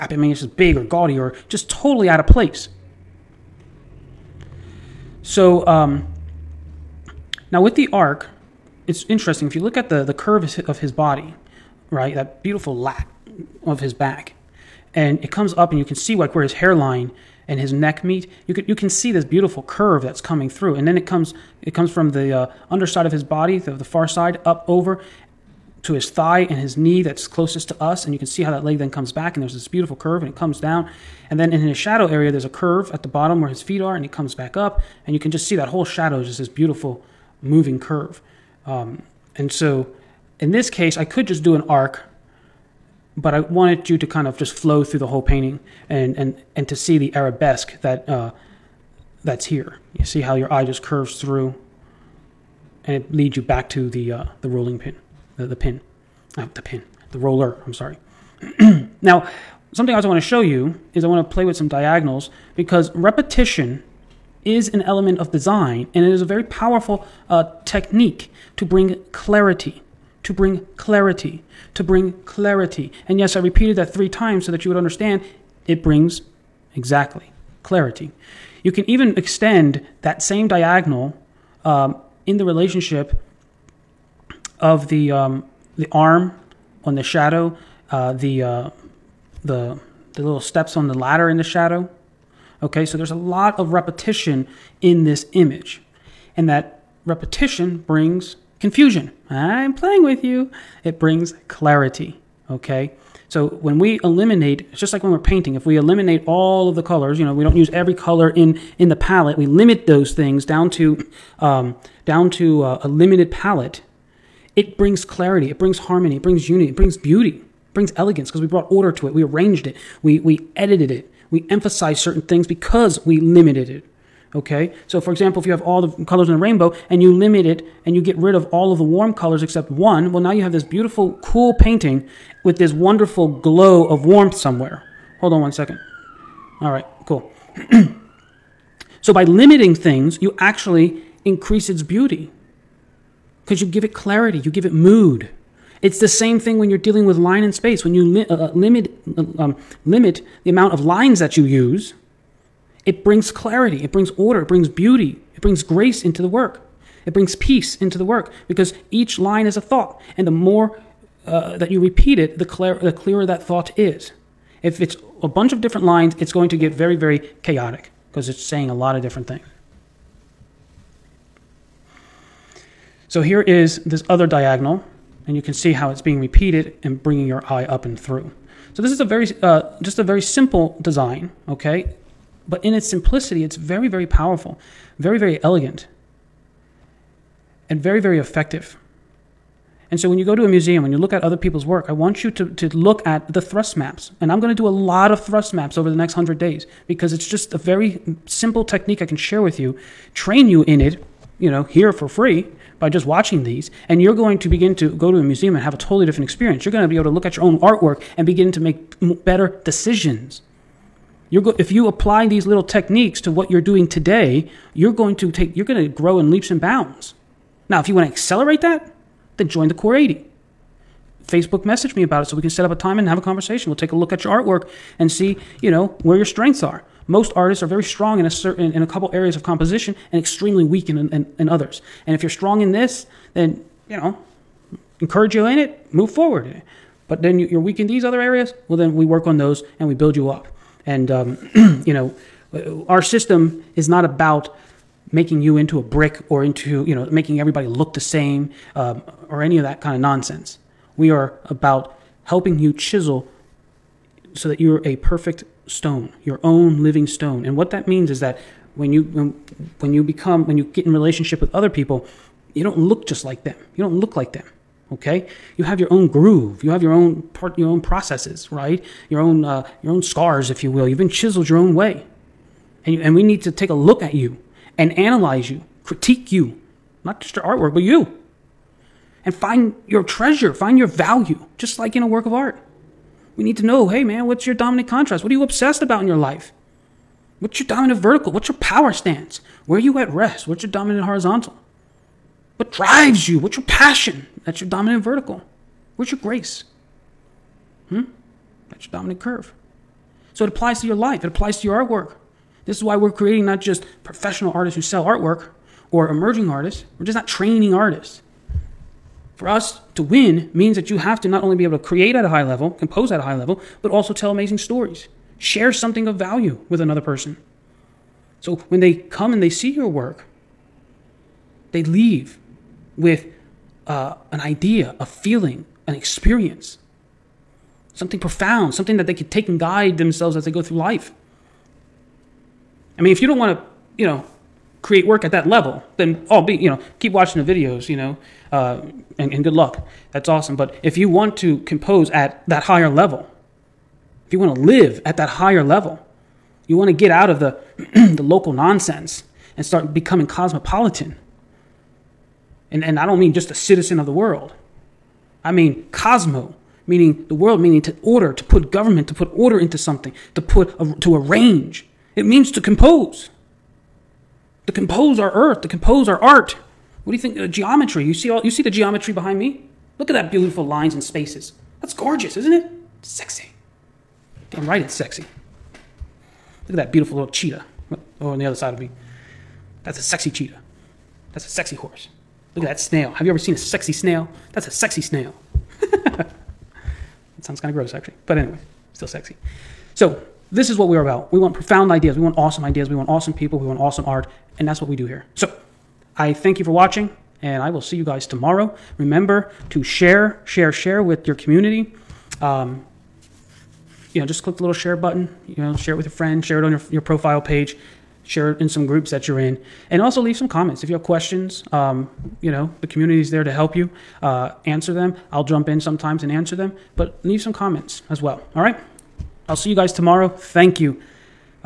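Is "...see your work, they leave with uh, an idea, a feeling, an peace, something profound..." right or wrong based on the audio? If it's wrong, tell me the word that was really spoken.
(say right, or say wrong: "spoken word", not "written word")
wrong: "experience", not "peace".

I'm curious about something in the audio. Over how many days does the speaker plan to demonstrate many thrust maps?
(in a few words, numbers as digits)
100.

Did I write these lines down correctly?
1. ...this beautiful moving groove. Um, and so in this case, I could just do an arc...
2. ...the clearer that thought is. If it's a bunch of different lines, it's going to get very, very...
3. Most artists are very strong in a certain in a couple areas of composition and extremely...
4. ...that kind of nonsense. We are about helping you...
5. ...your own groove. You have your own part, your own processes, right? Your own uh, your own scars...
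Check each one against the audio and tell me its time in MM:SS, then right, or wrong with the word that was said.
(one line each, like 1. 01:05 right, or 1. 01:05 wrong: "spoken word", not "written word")
1. 00:36 wrong: "curve", not "groove"
2. 02:42 right
3. 03:47 right
4. 04:09 right
5. 04:25 right.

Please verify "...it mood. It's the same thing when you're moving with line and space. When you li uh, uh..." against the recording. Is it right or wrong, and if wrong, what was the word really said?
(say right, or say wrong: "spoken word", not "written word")
wrong: "dealing", not "moving".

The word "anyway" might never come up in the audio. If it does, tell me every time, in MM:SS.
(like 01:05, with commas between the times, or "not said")
06:28.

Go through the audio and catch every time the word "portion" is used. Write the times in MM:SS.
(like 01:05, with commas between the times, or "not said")
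not said.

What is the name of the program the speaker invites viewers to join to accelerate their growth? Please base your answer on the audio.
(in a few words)
Core 80.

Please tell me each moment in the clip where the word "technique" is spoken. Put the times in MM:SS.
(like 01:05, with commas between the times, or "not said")
01:07, 03:18, 03:32.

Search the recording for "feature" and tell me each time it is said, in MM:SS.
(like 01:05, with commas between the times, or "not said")
not said.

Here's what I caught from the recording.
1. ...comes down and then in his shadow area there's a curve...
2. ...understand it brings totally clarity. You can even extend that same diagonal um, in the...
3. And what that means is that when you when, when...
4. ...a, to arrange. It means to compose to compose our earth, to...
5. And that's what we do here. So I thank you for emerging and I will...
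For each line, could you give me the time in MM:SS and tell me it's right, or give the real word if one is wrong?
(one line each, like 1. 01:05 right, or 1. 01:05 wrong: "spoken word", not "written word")
1. 00:30 right
2. 01:14 wrong: "exactly", not "totally"
3. 04:17 right
4. 06:00 right
5. 06:34 wrong: "watching", not "emerging".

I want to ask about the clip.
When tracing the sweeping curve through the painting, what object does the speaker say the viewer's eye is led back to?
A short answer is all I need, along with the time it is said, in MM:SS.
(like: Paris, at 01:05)
the roller, at 00:57.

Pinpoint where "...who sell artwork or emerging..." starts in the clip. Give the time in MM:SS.
05:04.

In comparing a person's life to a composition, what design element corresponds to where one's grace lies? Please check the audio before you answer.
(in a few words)
dominant curve.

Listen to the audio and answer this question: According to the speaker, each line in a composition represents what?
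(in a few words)
a thought.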